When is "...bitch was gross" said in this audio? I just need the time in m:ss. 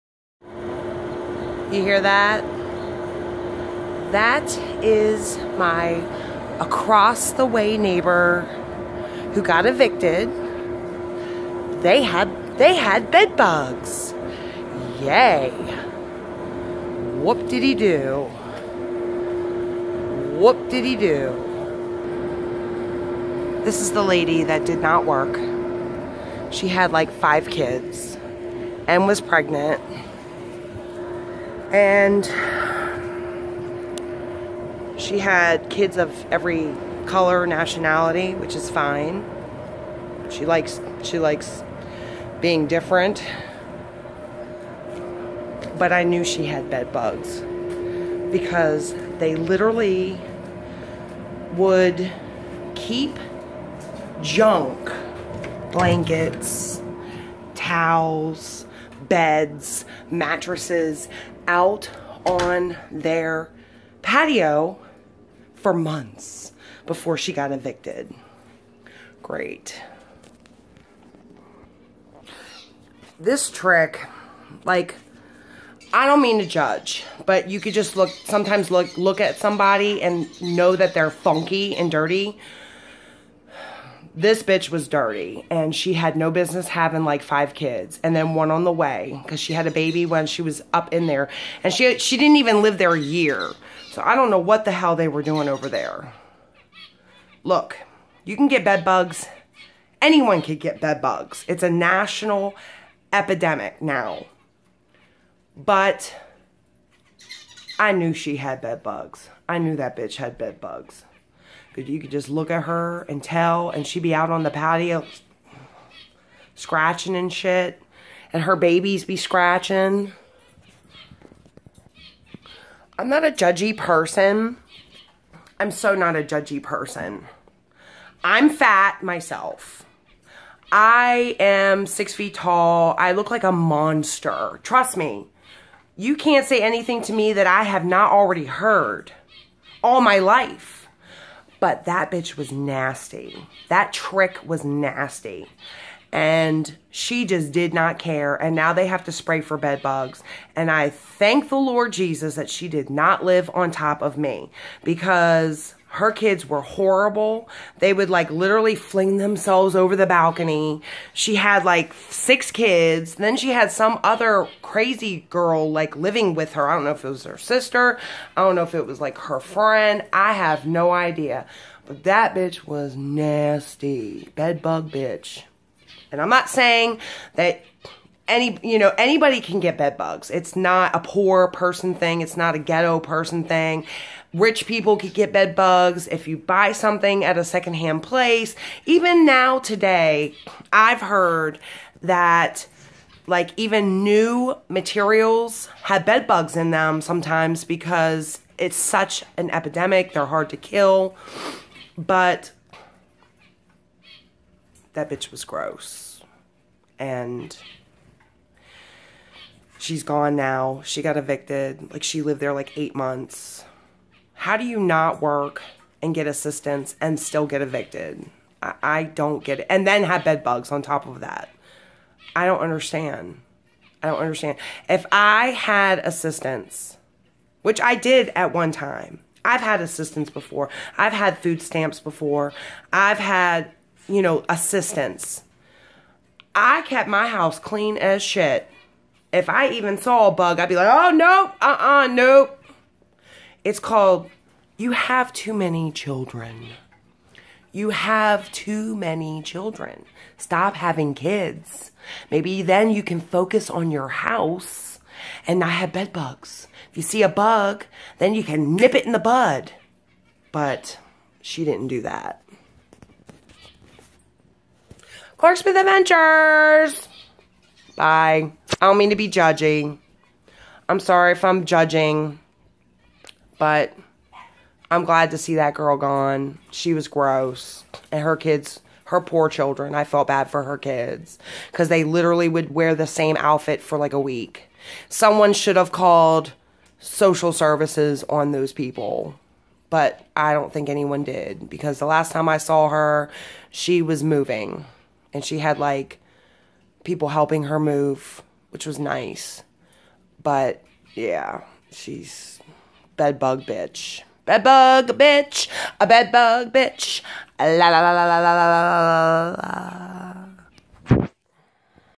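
3:25.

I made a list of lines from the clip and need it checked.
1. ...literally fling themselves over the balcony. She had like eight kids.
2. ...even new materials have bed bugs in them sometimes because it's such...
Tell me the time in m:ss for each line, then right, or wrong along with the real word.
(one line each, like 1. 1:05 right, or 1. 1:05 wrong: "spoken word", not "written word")
1. 2:38 wrong: "six", not "eight"
2. 3:13 right.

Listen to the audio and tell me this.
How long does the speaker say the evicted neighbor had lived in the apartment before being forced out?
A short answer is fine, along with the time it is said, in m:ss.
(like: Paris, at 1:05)
8 months, at 3:32.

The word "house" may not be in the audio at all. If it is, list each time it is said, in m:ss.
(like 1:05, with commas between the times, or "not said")
3:57, 4:14.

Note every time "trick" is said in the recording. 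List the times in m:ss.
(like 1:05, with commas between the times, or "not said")
1:13, 2:23.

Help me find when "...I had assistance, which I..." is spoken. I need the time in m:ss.
3:45.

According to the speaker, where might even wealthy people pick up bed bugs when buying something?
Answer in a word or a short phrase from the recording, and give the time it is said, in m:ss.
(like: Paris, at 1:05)
A secondhand place, at 3:07.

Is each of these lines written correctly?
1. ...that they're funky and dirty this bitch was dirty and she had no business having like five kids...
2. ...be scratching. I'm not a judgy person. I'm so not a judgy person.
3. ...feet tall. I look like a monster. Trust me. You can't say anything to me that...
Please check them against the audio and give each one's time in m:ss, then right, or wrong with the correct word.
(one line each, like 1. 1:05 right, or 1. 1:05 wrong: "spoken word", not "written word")
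1. 1:20 right
2. 1:59 right
3. 2:12 right.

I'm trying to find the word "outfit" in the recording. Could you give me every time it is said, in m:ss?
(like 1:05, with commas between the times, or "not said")
4:43.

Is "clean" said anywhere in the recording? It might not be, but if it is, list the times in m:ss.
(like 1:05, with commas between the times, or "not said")
3:57.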